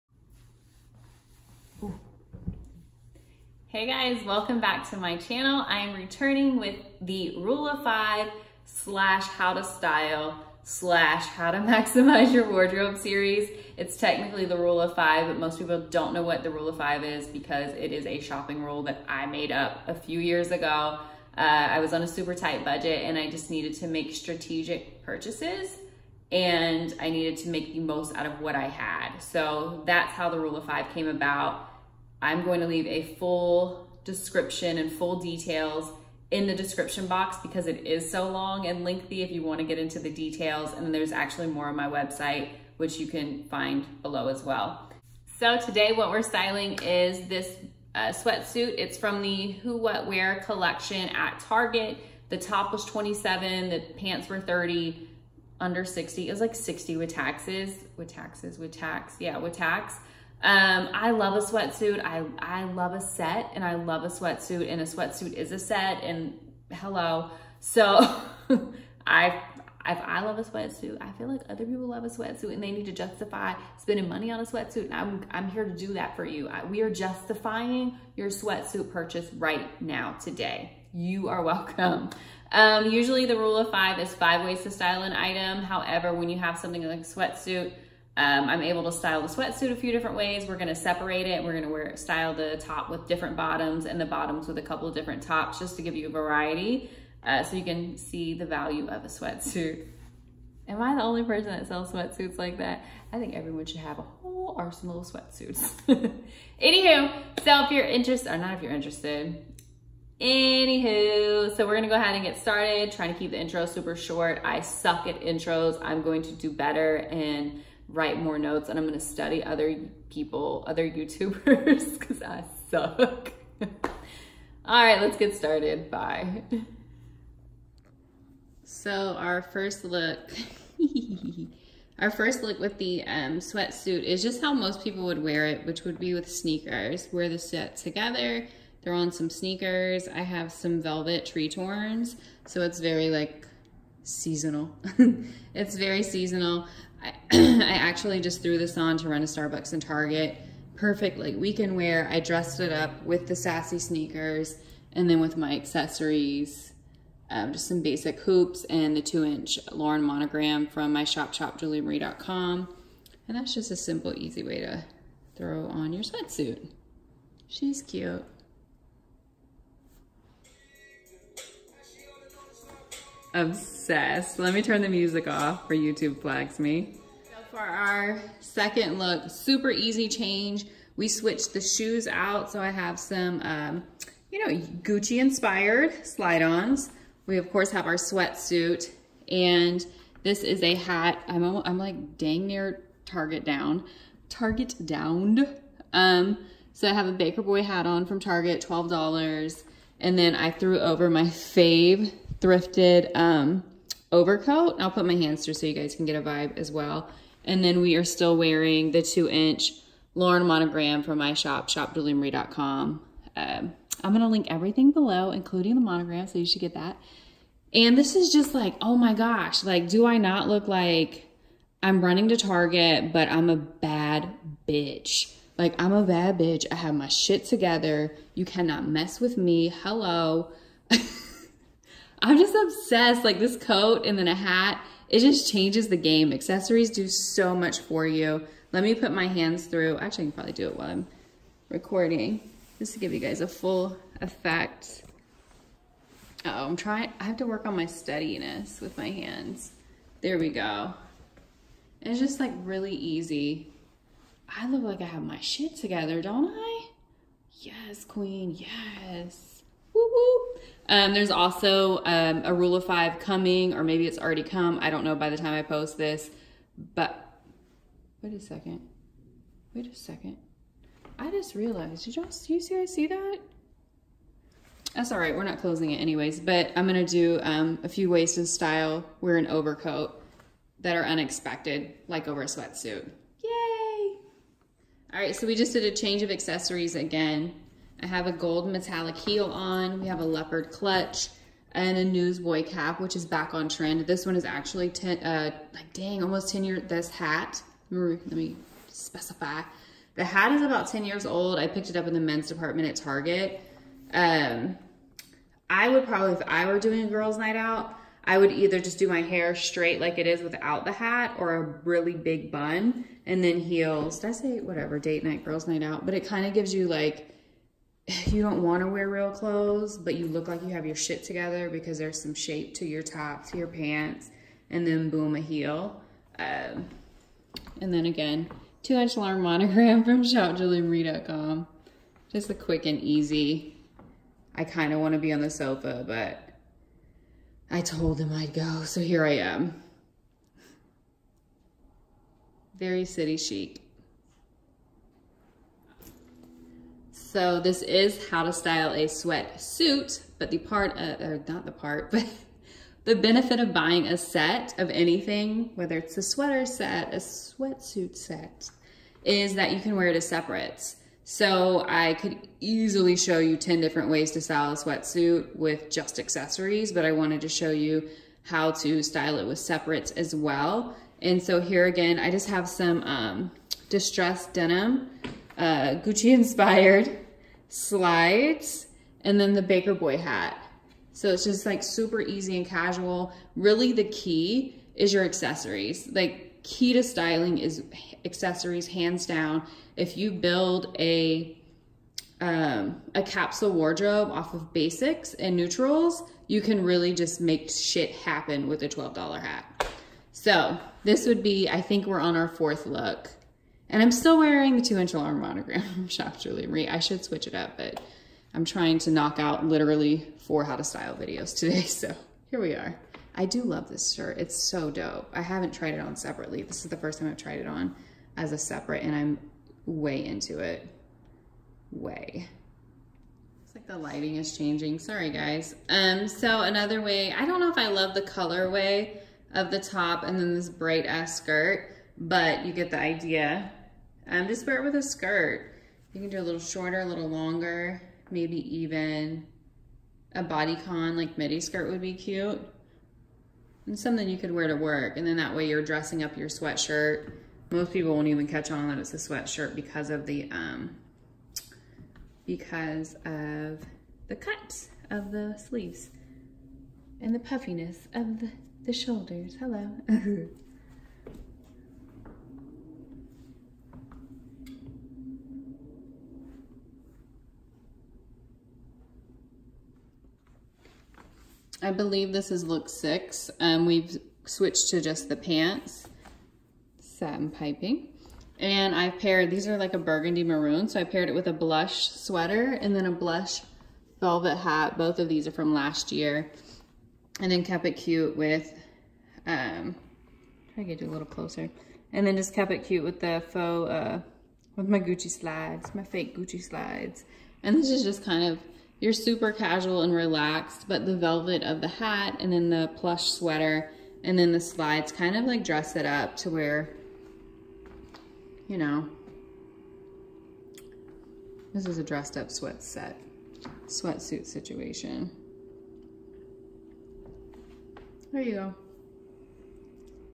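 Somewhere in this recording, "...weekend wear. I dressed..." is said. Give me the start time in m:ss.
2:31.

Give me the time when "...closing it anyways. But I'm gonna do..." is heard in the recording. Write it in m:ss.
4:35.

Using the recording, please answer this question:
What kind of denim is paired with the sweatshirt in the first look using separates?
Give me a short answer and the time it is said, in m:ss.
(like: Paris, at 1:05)
Distressed denim, at 6:13.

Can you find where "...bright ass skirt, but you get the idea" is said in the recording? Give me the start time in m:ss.
7:10.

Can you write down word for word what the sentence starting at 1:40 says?
Am I the only person that sells sweatsuits like that?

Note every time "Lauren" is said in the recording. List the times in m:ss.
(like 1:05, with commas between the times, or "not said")
2:39, 3:30, 5:29, 6:45.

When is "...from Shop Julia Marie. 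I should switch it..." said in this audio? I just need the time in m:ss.
6:45.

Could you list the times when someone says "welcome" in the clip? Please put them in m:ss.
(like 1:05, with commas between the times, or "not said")
0:04, 1:21.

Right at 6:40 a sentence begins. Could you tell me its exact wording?
So this would be, I think we're on our fourth look.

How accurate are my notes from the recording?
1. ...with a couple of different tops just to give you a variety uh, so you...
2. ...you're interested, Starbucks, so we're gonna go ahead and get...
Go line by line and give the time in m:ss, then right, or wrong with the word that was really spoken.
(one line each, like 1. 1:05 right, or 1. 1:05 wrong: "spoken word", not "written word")
1. 1:34 right
2. 1:48 wrong: "Anywho", not "Starbucks".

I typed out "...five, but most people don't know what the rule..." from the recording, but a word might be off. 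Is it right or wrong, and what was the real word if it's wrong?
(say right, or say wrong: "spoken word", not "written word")
right.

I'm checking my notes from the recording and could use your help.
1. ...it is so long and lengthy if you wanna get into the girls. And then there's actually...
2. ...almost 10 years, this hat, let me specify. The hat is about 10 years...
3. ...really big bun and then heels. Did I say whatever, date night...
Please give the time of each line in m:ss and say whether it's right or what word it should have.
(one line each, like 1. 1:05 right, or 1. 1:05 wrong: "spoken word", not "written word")
1. 0:37 wrong: "details", not "girls"
2. 4:56 right
3. 5:11 right.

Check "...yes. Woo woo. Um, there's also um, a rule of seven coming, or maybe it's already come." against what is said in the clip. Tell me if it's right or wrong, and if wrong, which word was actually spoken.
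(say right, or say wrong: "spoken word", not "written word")
wrong: "five", not "seven".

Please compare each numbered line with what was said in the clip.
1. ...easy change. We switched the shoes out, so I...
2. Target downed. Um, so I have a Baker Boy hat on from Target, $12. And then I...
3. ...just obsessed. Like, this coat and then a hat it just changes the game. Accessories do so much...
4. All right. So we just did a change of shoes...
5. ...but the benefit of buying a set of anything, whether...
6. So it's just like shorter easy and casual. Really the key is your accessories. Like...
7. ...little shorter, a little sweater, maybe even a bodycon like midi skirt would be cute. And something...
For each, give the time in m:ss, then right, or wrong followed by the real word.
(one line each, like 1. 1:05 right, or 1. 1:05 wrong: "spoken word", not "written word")
1. 2:59 right
2. 3:14 right
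3. 3:52 right
4. 4:45 wrong: "accessories", not "shoes"
5. 5:52 right
6. 6:21 wrong: "super", not "shorter"
7. 7:16 wrong: "longer", not "sweater".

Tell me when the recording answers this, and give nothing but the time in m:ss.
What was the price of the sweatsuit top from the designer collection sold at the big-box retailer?
0:52.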